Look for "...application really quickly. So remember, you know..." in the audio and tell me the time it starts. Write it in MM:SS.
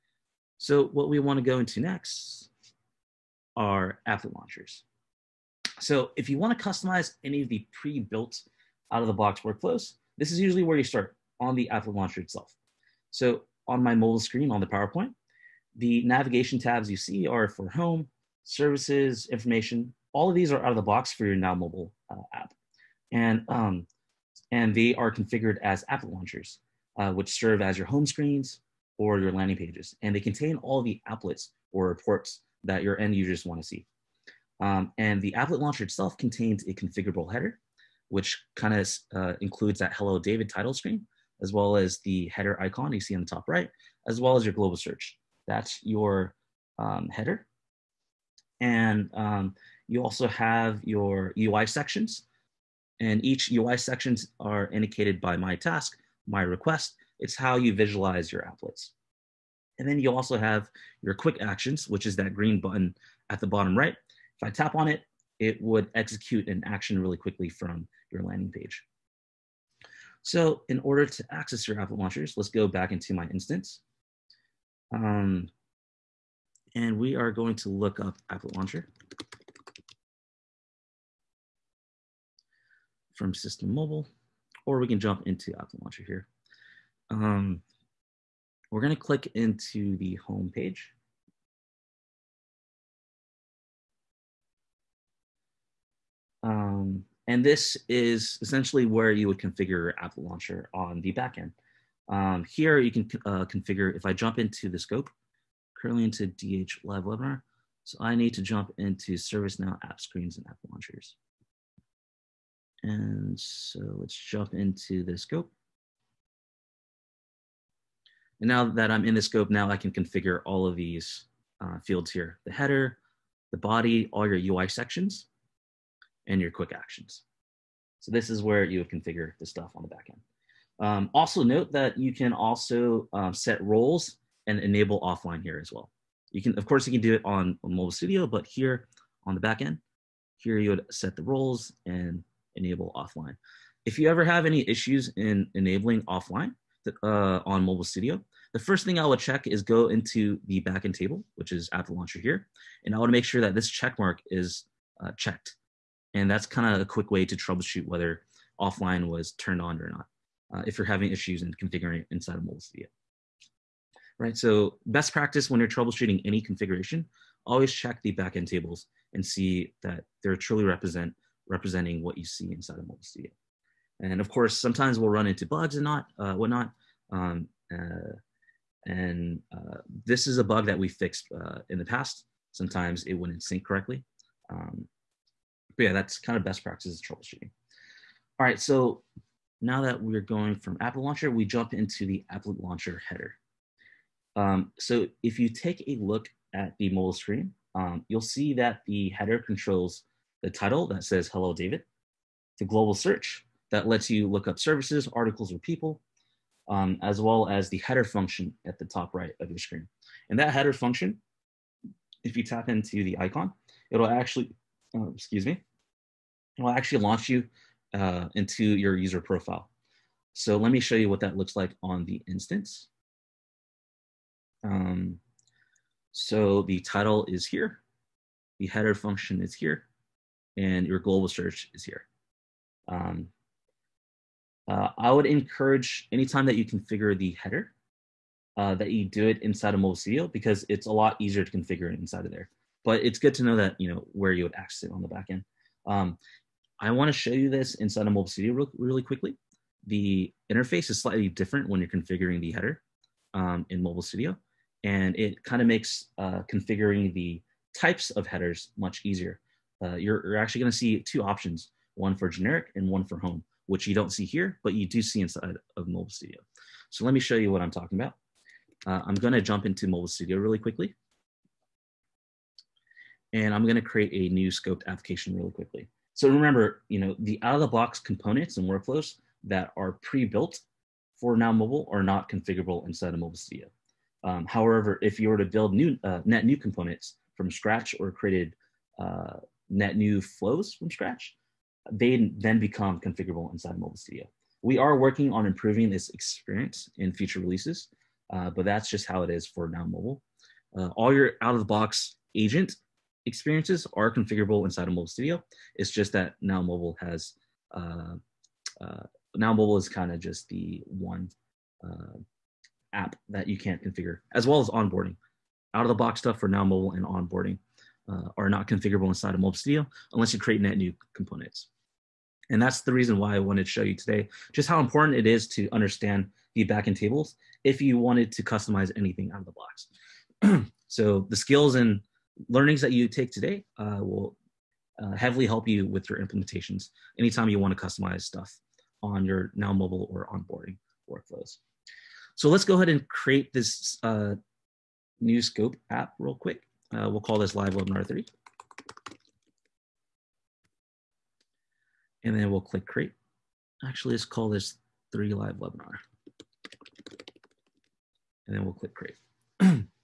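04:34.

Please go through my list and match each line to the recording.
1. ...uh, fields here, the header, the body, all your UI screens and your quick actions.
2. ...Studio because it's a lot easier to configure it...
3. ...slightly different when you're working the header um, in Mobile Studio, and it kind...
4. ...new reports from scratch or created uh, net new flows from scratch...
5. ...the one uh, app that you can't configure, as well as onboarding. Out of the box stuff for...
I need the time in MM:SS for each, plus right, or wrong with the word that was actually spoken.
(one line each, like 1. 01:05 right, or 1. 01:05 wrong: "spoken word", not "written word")
1. 02:01 wrong: "sections", not "screens"
2. 03:59 right
3. 04:11 wrong: "configuring", not "working"
4. 04:46 wrong: "components", not "reports"
5. 05:10 right.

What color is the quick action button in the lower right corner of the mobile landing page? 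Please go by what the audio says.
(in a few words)
Green.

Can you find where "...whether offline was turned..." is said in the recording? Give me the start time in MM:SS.
02:37.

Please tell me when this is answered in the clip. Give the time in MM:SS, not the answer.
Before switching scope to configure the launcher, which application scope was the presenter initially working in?
01:46.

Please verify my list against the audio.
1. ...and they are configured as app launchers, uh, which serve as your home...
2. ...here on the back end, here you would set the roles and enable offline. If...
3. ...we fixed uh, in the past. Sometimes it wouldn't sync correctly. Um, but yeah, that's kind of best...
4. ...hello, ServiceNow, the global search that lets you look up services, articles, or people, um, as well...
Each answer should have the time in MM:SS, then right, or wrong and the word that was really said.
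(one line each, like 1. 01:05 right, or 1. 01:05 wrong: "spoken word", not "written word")
1. 00:24 right
2. 02:18 right
3. 03:00 right
4. 03:21 wrong: "David", not "ServiceNow".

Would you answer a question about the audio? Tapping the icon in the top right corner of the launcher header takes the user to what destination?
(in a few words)
User profile.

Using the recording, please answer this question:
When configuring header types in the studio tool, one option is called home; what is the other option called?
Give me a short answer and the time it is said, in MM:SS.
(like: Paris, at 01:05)
Generic, at 04:22.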